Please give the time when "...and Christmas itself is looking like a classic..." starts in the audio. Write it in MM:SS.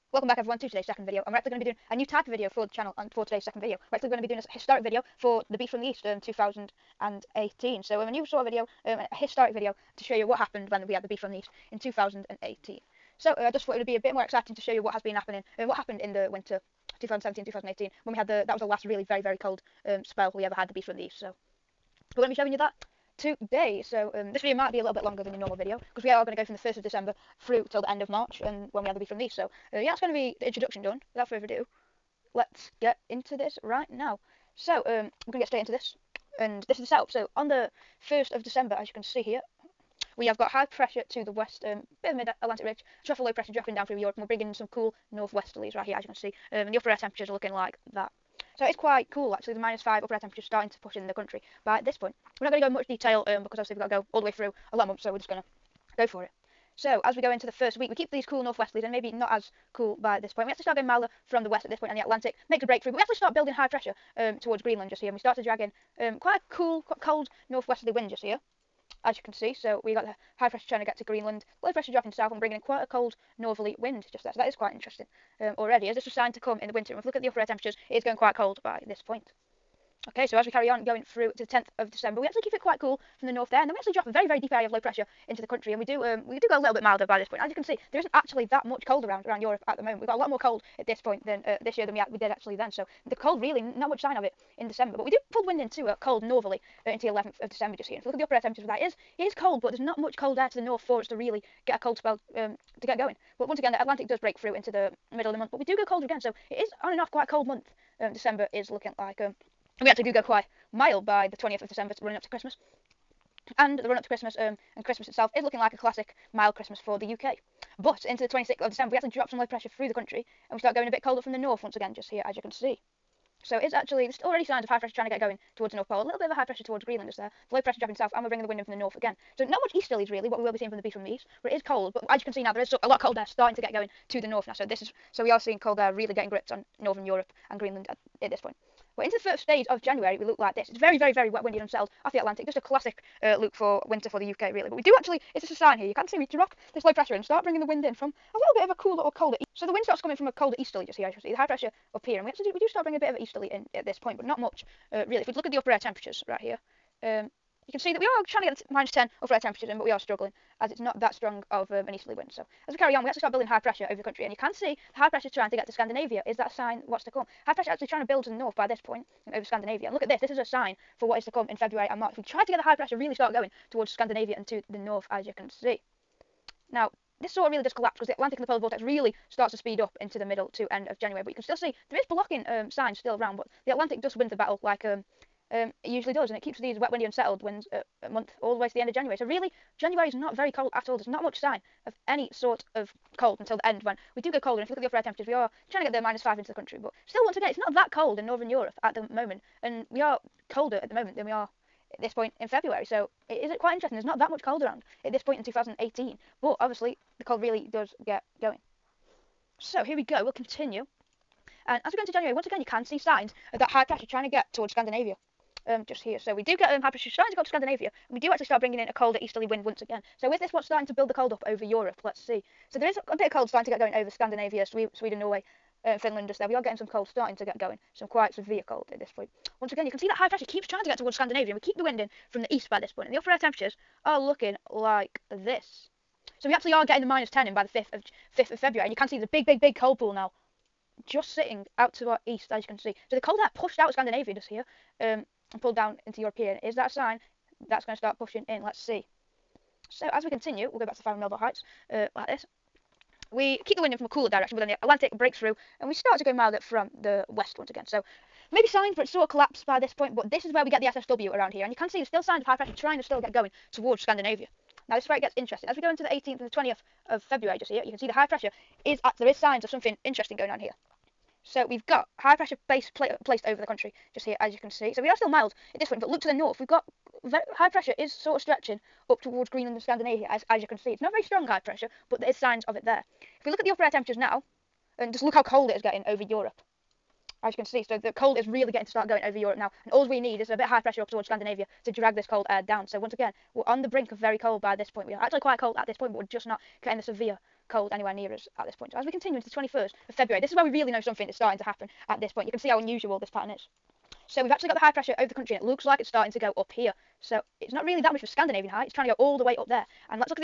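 01:54.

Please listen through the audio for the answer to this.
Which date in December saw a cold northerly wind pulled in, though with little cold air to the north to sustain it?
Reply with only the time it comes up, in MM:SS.
01:37.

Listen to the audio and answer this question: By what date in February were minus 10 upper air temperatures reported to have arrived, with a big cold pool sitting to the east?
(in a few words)
5th of February.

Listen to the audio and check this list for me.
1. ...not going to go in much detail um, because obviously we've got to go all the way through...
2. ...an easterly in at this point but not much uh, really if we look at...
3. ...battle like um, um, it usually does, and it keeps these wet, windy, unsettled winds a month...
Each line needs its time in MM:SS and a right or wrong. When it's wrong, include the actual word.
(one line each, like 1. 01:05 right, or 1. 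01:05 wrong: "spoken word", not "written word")
1. 00:52 right
2. 02:33 right
3. 03:04 right.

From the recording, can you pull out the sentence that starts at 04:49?
And all we need is a bit of high pressure up towards Scandinavia to drag this cold air down.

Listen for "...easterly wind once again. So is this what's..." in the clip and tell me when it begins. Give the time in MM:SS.
03:39.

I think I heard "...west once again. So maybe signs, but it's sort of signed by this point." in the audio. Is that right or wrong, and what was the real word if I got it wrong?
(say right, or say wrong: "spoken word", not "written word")
wrong: "collapsed", not "signed".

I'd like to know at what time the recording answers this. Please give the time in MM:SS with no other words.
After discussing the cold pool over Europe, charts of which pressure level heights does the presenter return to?
04:11.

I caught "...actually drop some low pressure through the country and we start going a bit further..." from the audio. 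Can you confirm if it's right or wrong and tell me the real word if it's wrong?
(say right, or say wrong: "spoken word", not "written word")
wrong: "colder", not "further".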